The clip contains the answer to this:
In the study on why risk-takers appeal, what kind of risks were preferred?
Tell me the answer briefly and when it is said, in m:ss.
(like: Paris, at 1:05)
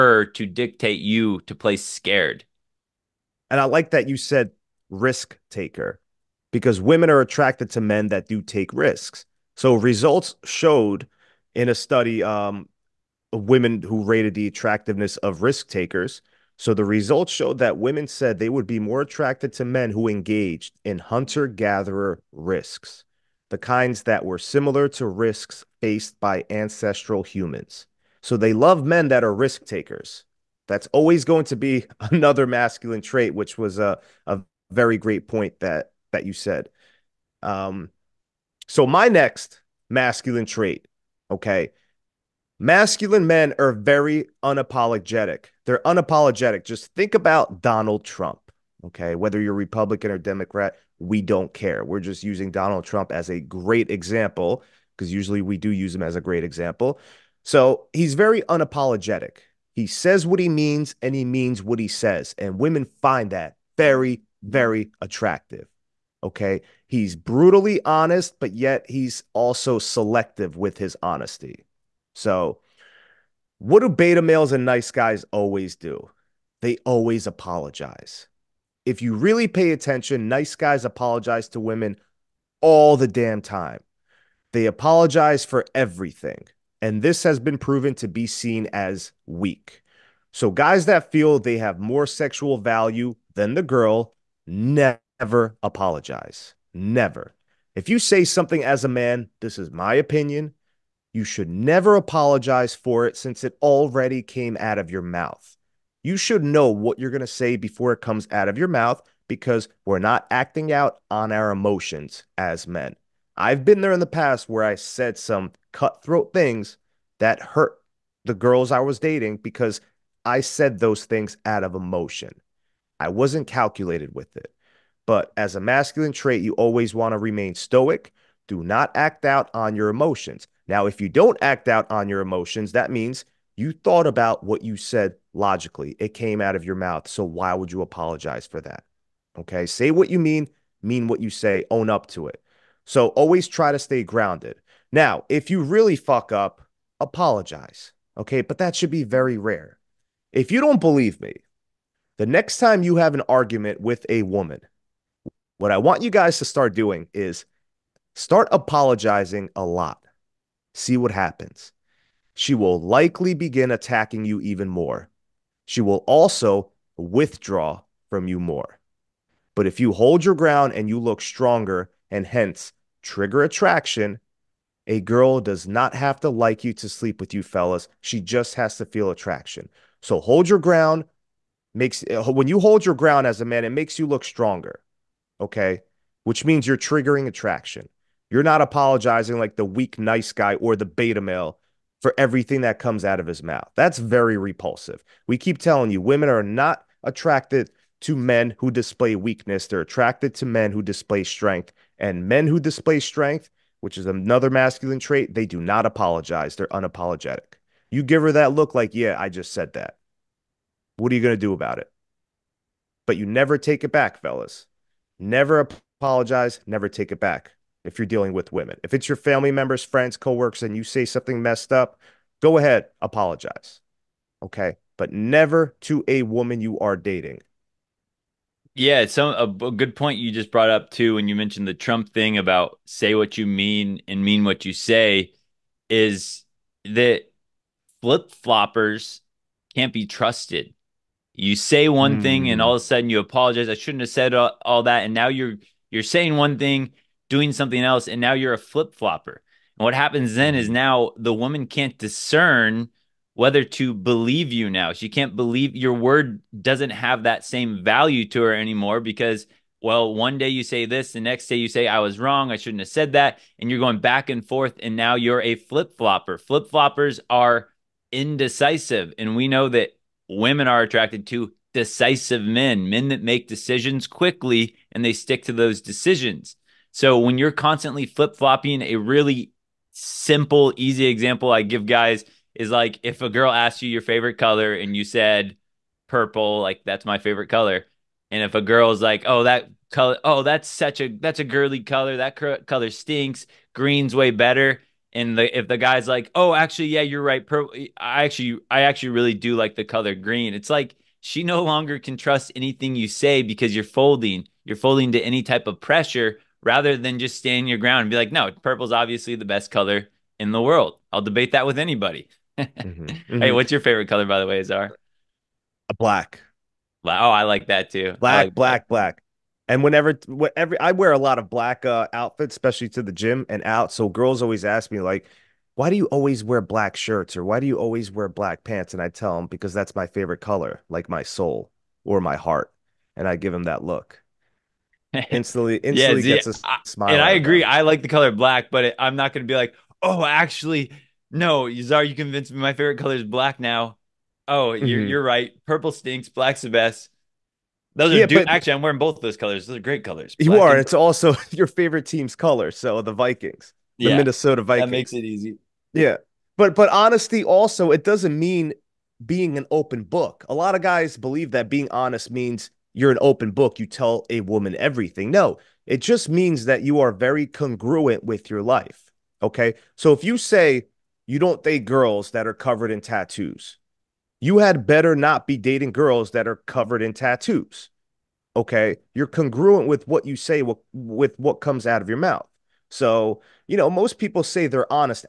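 Hunter gatherer risks, at 0:20.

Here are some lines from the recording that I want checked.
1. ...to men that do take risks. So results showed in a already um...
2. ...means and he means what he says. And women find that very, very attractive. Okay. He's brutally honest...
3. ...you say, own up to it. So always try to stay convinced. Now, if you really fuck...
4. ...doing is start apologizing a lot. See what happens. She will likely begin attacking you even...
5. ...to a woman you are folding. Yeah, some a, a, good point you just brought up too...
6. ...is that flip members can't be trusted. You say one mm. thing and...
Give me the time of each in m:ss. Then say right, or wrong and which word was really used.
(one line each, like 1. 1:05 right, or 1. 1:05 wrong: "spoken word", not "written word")
1. 0:07 wrong: "study", not "already"
2. 1:00 right
3. 2:21 wrong: "grounded", not "convinced"
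4. 2:36 right
5. 3:45 wrong: "dating", not "folding"
6. 3:55 wrong: "floppers", not "members".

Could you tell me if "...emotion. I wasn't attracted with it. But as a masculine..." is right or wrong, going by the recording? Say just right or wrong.
wrong.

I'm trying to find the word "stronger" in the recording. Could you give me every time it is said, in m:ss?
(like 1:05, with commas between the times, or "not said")
2:51, 3:04.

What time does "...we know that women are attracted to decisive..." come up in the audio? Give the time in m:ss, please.
4:29.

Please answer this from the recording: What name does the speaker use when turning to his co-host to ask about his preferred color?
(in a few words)
Azar.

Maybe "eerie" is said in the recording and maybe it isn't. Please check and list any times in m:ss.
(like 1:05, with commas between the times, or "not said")
not said.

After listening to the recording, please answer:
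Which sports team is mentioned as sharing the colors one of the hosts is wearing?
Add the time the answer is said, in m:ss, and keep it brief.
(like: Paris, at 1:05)
Minnesota Vikings, at 5:54.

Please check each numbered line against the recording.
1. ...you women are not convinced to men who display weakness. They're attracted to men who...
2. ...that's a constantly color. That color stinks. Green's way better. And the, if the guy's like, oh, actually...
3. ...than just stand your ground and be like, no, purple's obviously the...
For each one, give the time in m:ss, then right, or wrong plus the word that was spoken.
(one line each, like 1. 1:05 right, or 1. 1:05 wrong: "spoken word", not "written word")
1. 3:15 wrong: "attracted", not "convinced"
2. 4:51 wrong: "girly", not "constantly"
3. 5:06 right.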